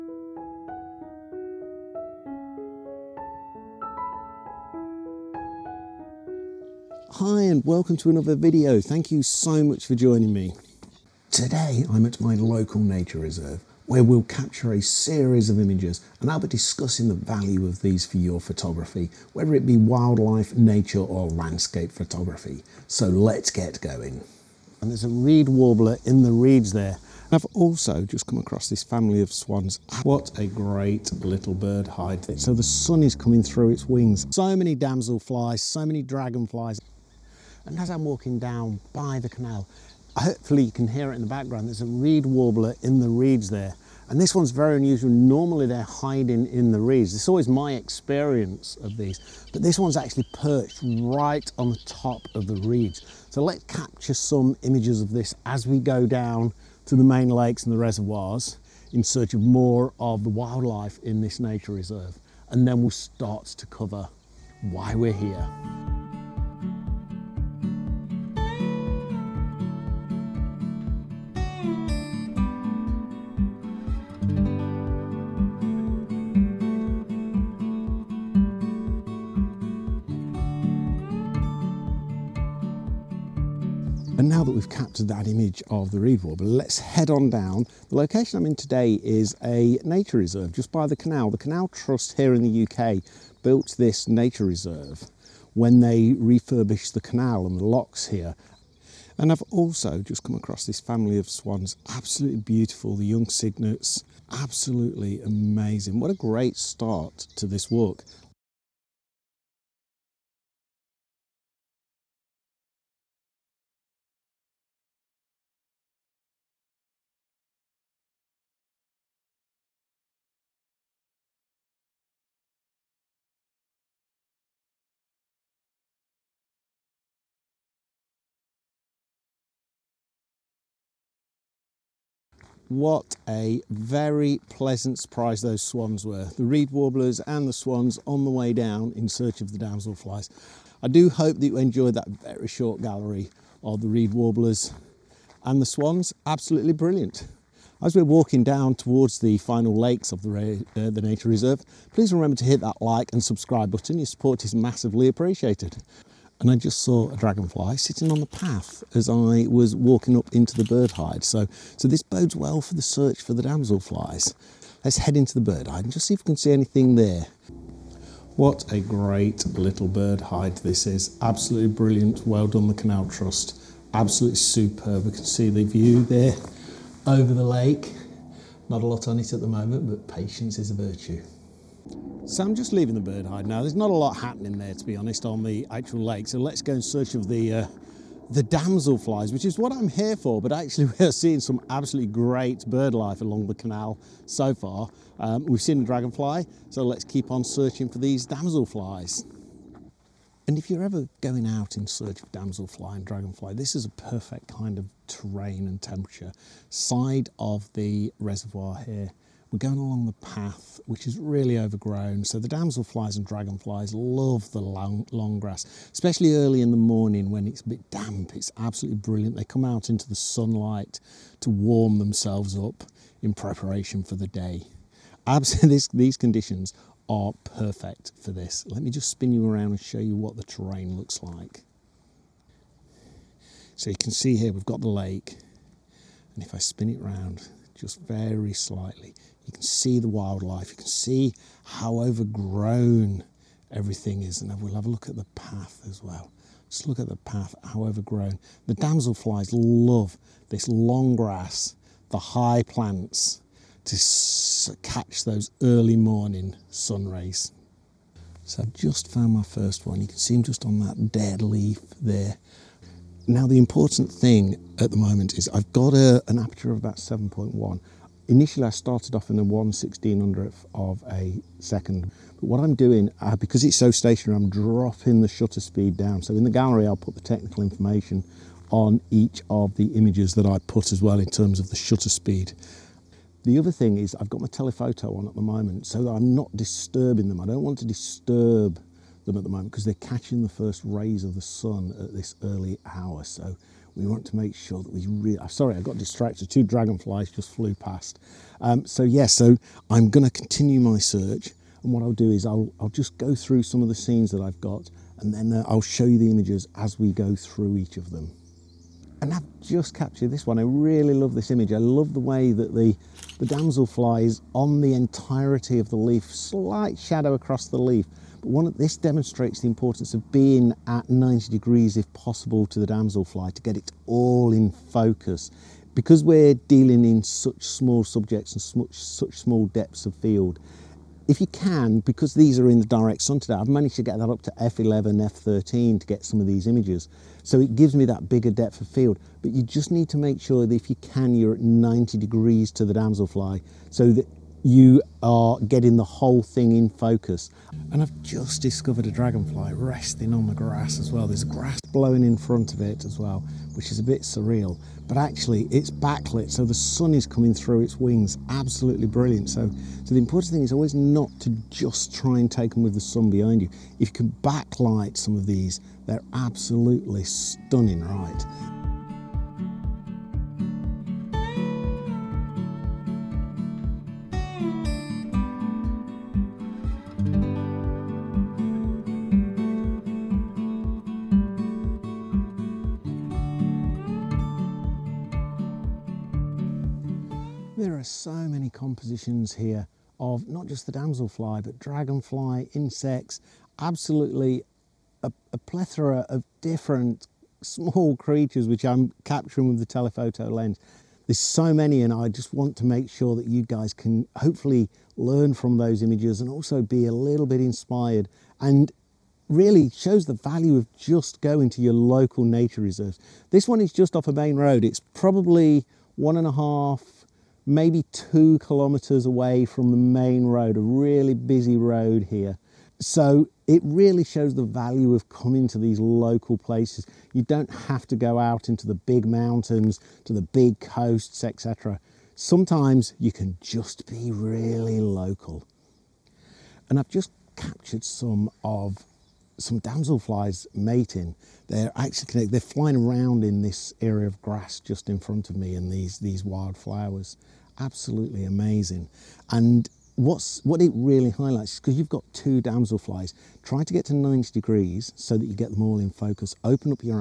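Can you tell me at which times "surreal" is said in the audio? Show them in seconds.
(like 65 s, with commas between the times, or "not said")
354 s.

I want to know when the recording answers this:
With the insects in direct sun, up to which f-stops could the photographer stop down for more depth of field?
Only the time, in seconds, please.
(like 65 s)
334 s.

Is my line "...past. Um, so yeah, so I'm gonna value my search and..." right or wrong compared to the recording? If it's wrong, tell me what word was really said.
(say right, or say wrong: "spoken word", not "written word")
wrong: "continue", not "value".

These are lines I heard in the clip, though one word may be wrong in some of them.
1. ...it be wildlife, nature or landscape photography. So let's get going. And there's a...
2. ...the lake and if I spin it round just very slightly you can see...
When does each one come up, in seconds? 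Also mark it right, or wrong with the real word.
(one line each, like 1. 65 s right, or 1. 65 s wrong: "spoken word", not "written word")
1. 19 s right
2. 234 s right.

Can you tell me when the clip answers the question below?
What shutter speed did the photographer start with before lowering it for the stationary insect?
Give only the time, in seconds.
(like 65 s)
269 s.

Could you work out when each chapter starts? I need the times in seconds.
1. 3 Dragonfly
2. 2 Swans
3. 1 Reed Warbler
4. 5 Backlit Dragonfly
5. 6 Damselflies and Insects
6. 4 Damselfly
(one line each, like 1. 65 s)
1. 139 s
2. 84 s
3. 34 s
4. 344 s
5. 439 s
6. 199 s.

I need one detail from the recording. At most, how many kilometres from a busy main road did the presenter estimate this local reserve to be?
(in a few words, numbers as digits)
2 kilometers.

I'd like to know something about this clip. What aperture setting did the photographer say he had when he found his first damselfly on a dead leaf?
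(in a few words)
7.1.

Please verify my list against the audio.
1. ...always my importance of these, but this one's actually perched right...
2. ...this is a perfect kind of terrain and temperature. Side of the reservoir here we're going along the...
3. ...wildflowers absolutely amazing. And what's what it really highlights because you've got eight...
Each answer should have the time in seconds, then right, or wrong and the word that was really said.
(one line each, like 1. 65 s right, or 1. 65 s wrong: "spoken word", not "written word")
1. 47 s wrong: "experience", not "importance"
2. 203 s right
3. 446 s wrong: "two", not "eight".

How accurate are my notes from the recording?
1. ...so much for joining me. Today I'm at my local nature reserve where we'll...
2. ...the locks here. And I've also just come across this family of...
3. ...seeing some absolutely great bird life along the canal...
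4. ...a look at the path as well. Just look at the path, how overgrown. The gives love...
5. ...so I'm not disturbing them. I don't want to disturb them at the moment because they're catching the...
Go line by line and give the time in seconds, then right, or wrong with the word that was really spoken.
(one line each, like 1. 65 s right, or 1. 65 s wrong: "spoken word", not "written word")
1. 9 s right
2. 97 s right
3. 191 s right
4. 244 s wrong: "damselflies", not "gives"
5. 285 s right.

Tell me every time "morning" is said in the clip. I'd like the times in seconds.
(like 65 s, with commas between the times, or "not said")
216 s, 255 s.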